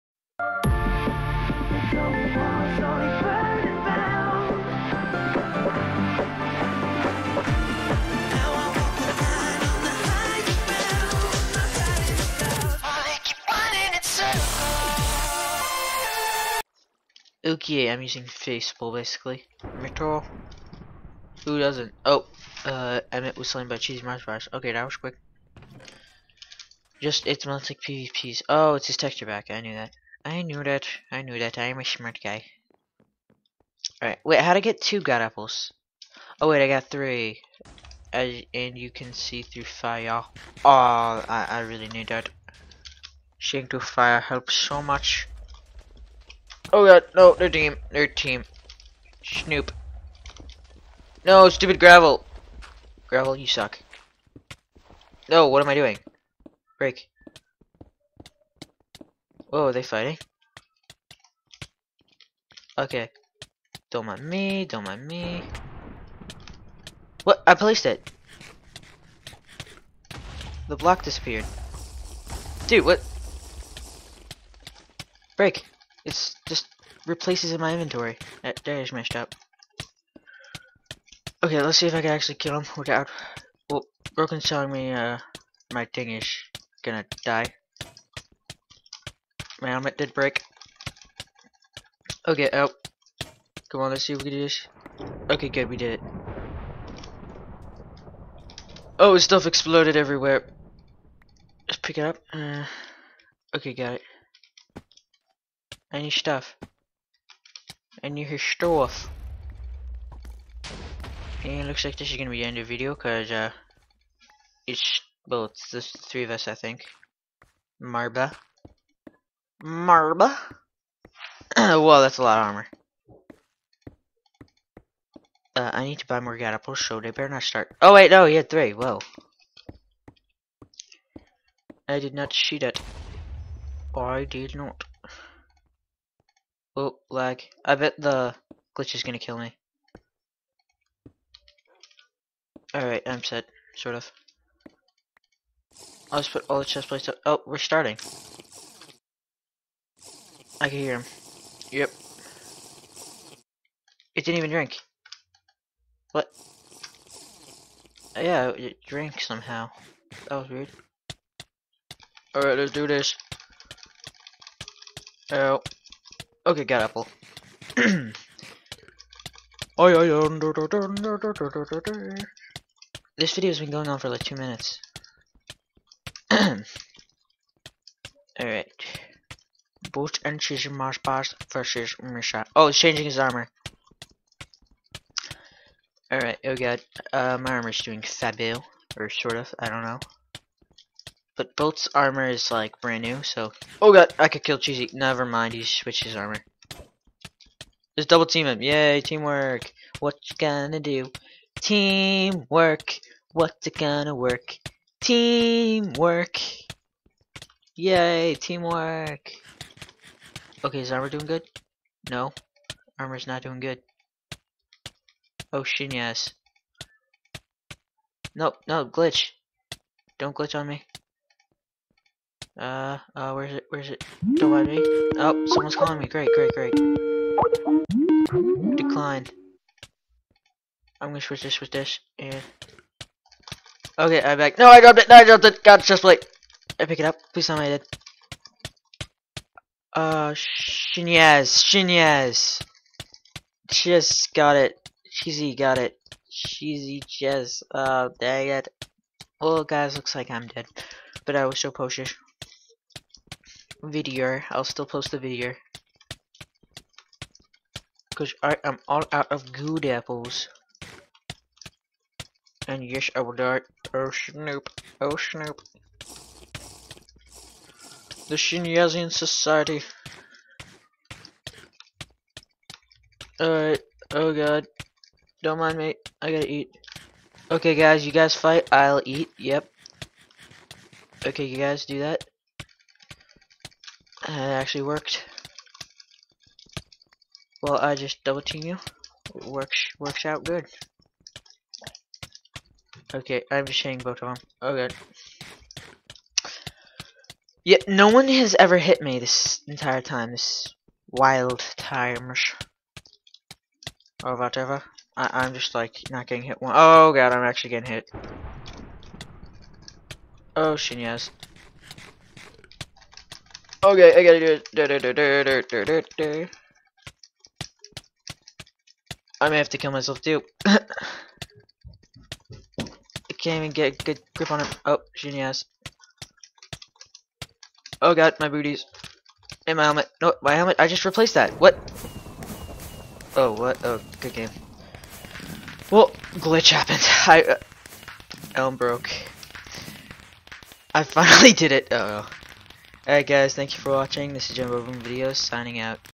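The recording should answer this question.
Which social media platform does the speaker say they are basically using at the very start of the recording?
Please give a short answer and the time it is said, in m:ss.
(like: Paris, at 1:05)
Facebook, at 0:18.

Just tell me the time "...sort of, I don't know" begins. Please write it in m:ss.
3:09.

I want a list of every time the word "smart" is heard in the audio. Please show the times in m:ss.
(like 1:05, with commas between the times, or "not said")
0:31.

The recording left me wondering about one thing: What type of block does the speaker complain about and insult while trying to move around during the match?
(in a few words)
Gravel.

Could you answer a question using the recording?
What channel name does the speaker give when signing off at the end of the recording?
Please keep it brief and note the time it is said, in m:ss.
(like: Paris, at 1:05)
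Jumbo Boom Videos, at 5:44.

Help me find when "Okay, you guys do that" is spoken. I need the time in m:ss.
4:41.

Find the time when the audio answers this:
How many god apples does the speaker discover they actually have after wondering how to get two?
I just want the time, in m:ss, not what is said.
0:36.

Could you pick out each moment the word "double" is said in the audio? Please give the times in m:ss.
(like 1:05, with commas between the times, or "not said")
3:18, 4:48.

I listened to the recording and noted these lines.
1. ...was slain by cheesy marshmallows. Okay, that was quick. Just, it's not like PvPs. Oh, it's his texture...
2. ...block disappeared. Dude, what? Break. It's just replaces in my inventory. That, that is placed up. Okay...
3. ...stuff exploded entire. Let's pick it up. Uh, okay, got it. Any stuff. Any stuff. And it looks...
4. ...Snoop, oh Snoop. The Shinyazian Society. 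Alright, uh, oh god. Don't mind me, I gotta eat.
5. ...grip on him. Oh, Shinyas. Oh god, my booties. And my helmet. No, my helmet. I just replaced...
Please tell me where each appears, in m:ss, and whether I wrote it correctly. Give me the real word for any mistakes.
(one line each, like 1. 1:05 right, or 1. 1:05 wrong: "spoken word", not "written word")
1. 0:23 right
2. 1:10 wrong: "messed", not "placed"
3. 1:39 wrong: "everywhere", not "entire"
4. 4:24 right
5. 5:24 right.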